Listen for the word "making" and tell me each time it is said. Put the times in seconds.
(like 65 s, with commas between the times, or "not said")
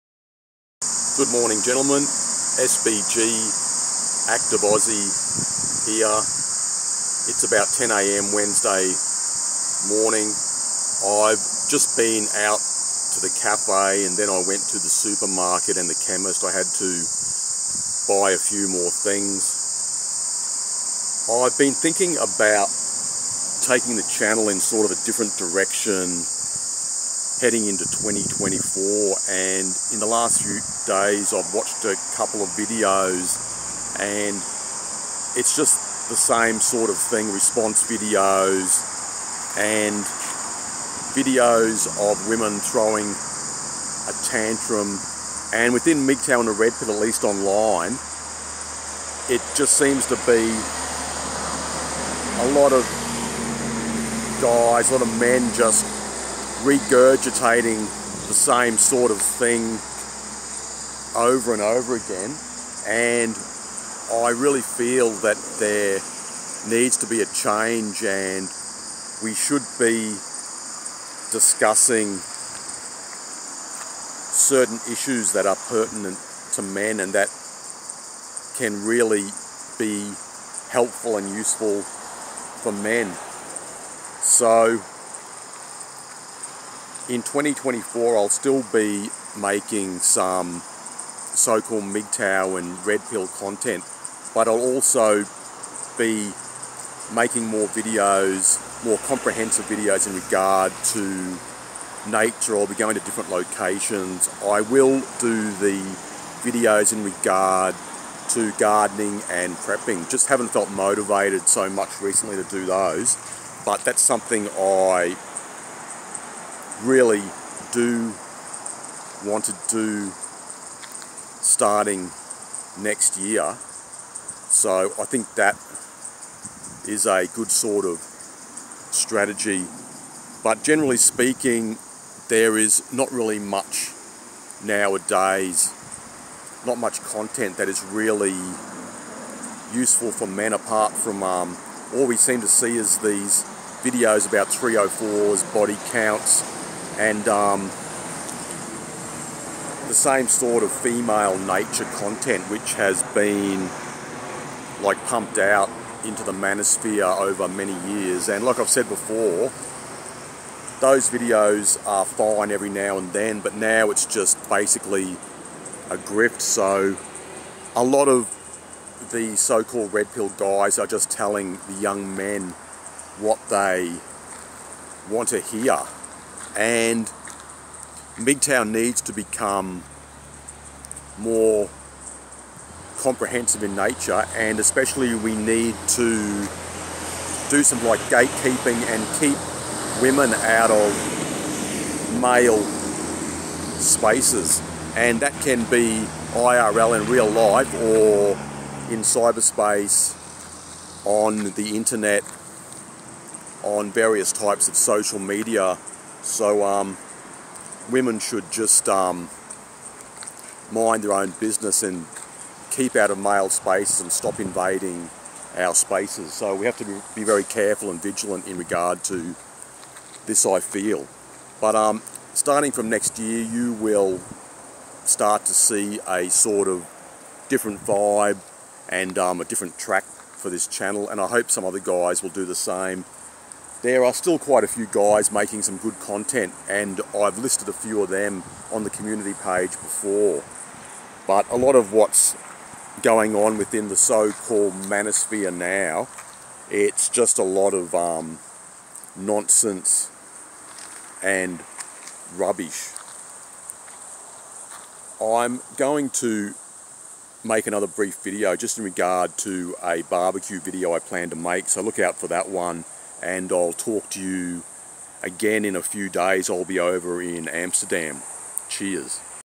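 89 s, 97 s, 235 s.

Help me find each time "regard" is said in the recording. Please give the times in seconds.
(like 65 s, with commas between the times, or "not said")
100 s, 107 s, 218 s, 258 s.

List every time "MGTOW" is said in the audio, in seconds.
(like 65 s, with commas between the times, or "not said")
46 s, 91 s, 178 s.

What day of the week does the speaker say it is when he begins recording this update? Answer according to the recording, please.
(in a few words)
Wednesday.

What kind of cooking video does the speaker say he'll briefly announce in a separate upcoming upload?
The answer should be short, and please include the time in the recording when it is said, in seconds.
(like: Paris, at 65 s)
A barbecue video, at 260 s.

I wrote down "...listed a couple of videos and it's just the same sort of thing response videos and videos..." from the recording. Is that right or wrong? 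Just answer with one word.
wrong.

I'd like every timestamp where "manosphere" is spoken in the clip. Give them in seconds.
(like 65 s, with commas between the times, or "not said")
156 s, 244 s.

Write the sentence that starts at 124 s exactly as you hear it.
So I think that is a good sort of strategy.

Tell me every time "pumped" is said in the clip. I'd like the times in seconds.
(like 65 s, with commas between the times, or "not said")
155 s.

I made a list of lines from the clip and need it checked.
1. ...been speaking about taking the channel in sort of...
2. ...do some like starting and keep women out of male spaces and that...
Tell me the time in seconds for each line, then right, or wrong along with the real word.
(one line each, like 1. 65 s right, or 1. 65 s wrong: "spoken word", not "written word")
1. 21 s wrong: "thinking", not "speaking"
2. 187 s wrong: "gatekeeping", not "starting".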